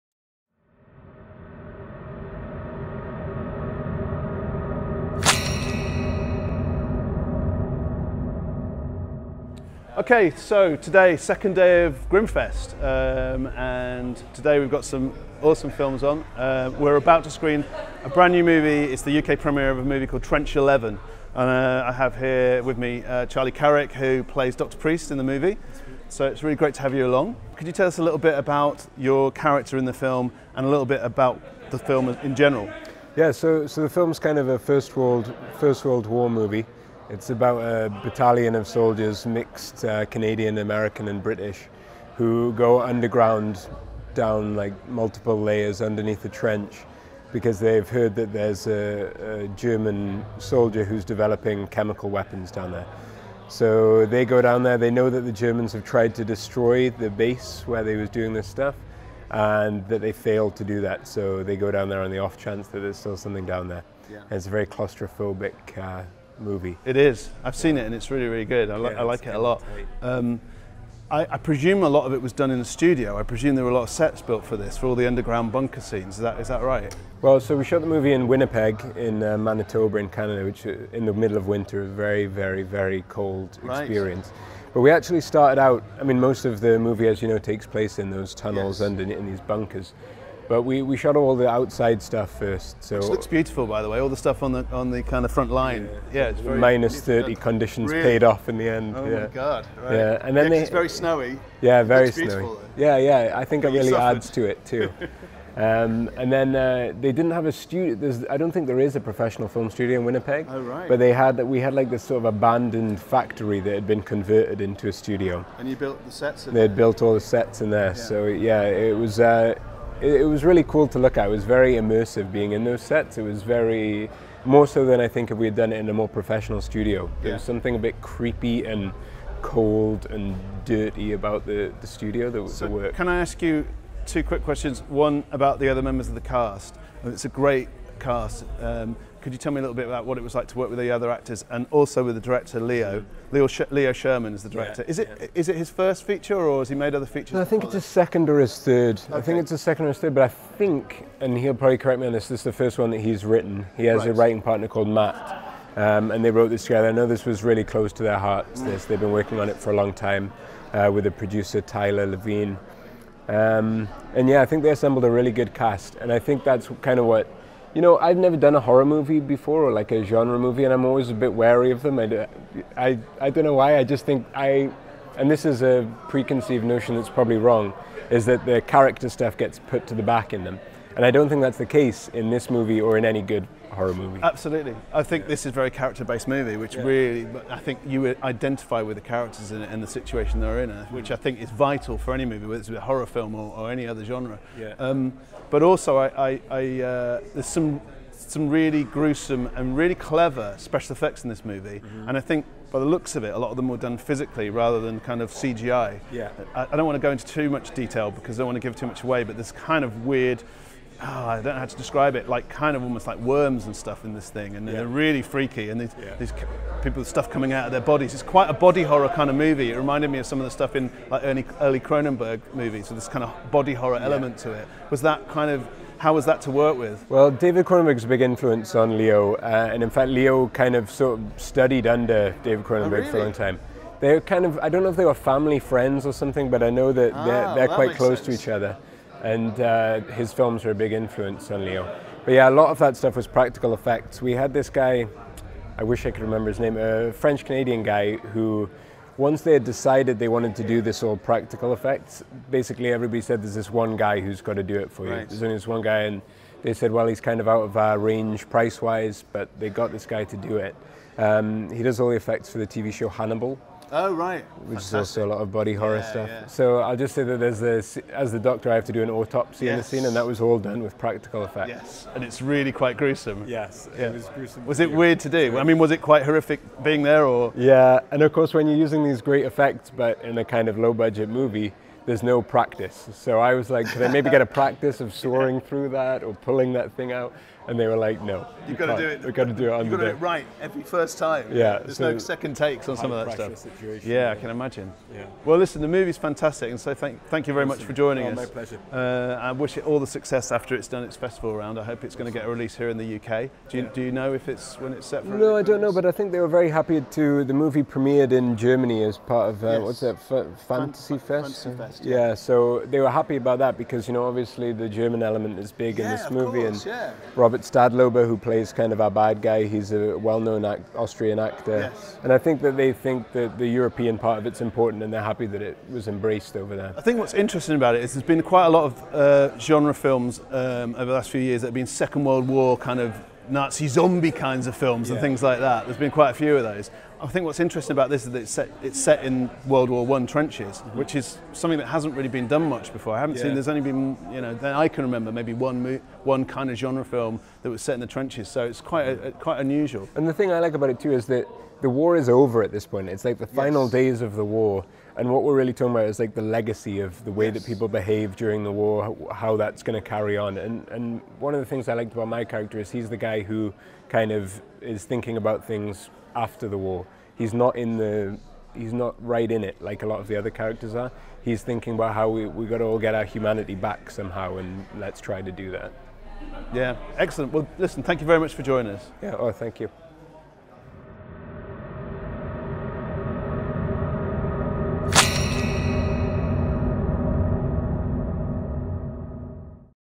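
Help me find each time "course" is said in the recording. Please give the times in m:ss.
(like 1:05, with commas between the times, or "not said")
4:38, 5:16.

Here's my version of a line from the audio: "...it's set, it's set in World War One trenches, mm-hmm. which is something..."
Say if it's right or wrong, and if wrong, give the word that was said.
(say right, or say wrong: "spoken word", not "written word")
right.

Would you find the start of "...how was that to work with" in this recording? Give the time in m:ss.
3:45.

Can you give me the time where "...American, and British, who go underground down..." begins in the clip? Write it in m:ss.
0:40.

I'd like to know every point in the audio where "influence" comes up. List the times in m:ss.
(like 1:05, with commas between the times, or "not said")
3:48, 4:00.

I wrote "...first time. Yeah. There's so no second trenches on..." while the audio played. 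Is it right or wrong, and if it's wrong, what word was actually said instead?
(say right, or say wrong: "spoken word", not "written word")
wrong: "takes", not "trenches".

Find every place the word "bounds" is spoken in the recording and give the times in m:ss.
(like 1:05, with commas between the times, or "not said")
not said.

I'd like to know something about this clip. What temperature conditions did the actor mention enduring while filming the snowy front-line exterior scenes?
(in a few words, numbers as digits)
minus 30.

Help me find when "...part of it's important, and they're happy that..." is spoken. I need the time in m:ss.
5:24.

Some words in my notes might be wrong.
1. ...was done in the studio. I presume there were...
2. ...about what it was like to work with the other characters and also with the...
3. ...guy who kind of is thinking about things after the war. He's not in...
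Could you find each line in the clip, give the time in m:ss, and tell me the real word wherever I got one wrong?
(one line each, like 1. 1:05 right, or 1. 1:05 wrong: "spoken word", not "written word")
1. 1:12 right
2. 2:19 wrong: "actors", not "characters"
3. 6:03 right.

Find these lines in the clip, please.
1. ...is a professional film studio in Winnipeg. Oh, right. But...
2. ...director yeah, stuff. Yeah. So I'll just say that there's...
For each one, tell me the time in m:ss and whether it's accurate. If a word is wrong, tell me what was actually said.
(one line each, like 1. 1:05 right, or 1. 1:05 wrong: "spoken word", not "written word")
1. 1:48 right
2. 4:25 wrong: "horror", not "director".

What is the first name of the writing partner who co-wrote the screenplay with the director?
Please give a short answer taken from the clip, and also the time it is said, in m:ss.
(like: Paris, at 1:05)
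Matt, at 2:34.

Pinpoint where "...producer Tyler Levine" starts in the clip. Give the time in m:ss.
2:41.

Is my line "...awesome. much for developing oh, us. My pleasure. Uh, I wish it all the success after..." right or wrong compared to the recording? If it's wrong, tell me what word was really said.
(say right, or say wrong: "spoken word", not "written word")
wrong: "joining", not "developing".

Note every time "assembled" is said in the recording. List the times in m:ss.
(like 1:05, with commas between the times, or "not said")
2:44.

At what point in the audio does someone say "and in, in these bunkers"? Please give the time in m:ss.
1:28.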